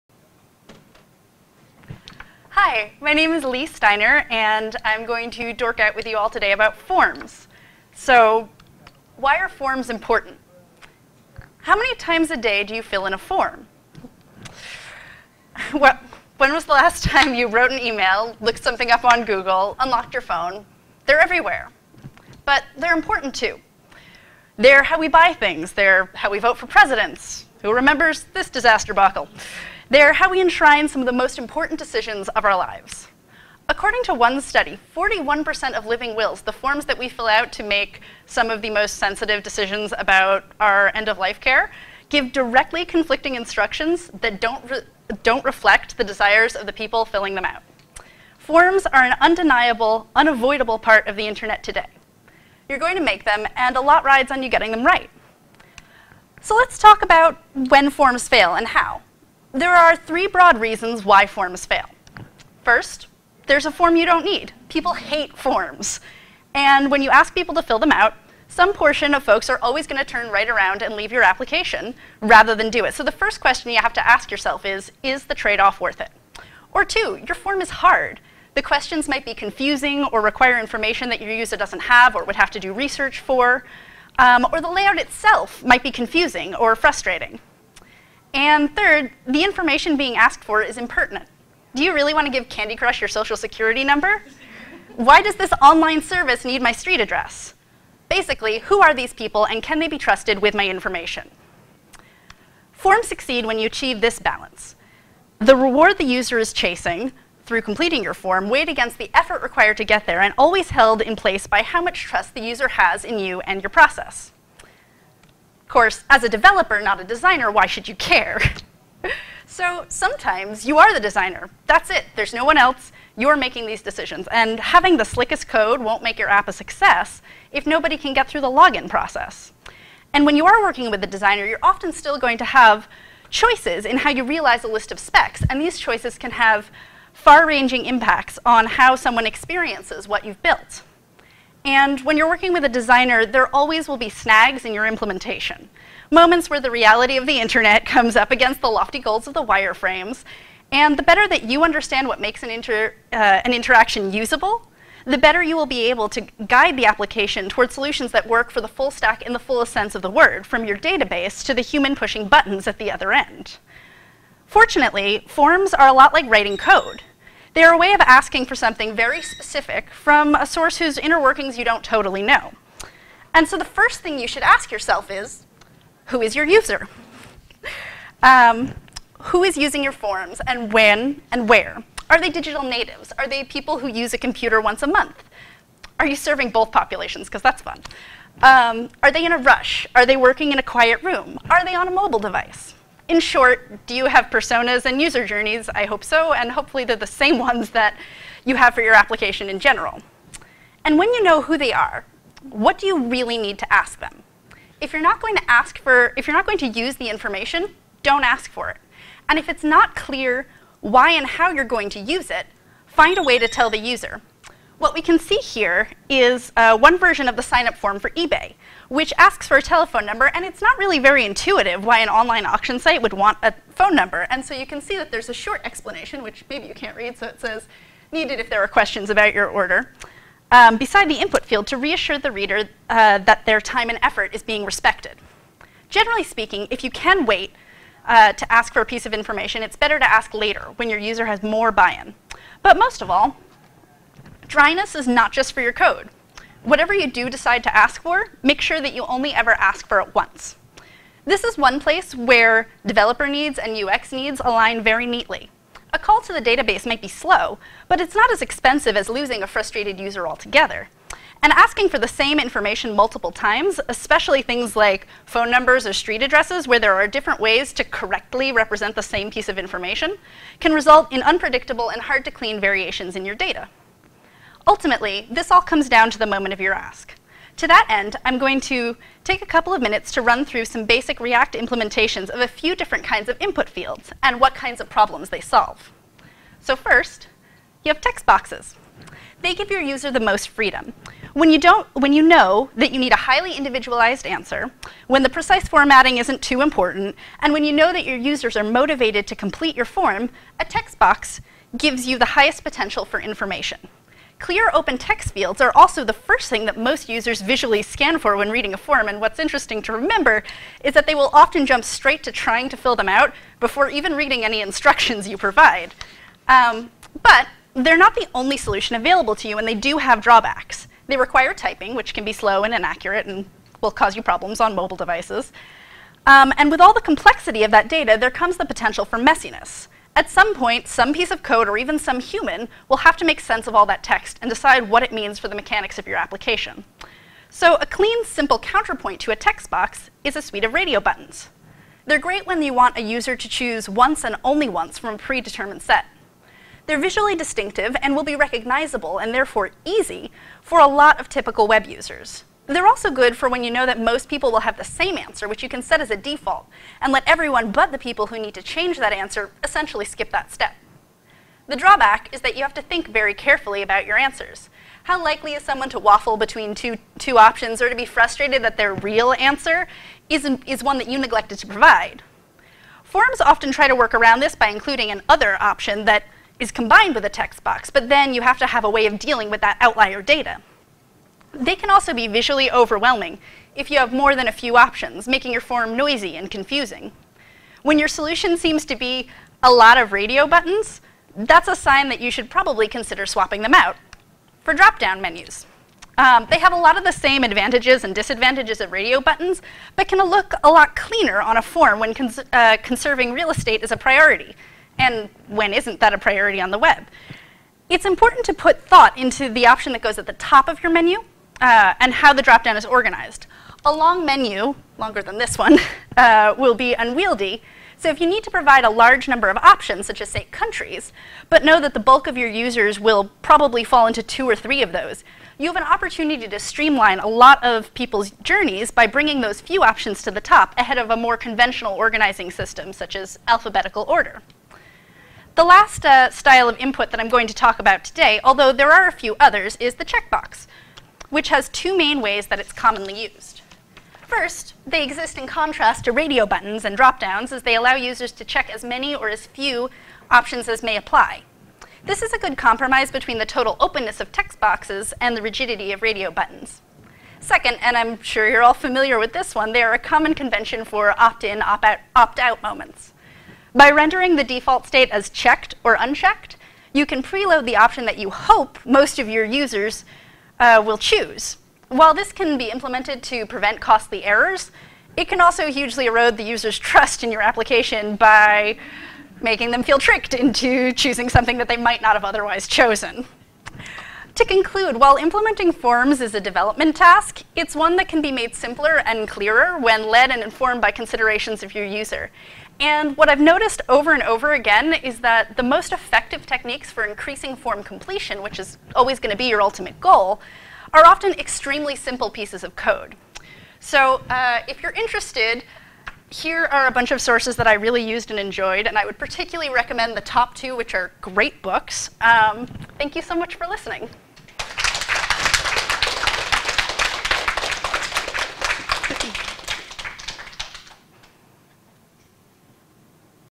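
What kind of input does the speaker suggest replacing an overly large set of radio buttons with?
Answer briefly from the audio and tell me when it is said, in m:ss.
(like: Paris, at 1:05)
drop-down menus, at 6:34.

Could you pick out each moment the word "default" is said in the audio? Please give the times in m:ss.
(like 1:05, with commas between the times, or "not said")
5:56, 7:44.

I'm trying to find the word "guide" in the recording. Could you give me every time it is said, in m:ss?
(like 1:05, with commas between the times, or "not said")
2:36.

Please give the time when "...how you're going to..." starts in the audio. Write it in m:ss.
3:31.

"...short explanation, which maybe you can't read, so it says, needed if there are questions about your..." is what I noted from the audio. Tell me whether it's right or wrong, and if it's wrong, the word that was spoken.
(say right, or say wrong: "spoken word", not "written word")
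right.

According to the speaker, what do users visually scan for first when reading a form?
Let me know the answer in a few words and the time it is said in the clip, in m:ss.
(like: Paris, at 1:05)
open text fields, at 5:04.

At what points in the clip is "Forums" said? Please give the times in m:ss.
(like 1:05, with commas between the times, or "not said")
6:13.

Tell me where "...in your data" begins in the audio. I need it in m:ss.
4:33.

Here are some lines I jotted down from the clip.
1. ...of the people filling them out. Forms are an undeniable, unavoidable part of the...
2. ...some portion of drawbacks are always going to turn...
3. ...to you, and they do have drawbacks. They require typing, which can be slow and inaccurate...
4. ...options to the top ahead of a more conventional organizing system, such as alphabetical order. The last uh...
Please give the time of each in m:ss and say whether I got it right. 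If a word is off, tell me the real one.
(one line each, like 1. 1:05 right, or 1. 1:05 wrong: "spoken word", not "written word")
1. 0:46 right
2. 1:08 wrong: "folks", not "drawbacks"
3. 5:19 right
4. 7:09 right.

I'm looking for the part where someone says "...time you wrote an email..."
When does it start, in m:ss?
0:17.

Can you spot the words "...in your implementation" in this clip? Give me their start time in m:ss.
2:24.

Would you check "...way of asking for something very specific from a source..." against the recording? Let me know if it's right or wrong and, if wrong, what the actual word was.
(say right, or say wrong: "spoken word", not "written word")
right.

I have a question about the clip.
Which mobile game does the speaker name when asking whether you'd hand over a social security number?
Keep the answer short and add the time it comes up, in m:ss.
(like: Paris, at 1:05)
Candy Crush, at 1:32.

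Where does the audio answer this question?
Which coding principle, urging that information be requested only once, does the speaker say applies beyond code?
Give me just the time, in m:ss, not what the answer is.
4:04.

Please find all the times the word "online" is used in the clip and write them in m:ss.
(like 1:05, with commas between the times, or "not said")
1:35, 3:42.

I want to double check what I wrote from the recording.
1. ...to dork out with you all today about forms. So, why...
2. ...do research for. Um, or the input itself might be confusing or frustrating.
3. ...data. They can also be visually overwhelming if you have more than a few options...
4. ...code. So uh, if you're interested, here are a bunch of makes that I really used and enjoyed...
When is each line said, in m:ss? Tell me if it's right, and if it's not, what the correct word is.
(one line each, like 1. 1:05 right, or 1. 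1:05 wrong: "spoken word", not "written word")
1. 0:05 right
2. 1:22 wrong: "layout", not "input"
3. 6:20 right
4. 8:22 wrong: "sources", not "makes".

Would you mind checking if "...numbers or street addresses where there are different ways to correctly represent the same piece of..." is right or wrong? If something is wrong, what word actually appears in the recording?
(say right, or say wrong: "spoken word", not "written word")
right.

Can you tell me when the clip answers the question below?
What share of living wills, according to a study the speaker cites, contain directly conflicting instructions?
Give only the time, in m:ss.
0:34.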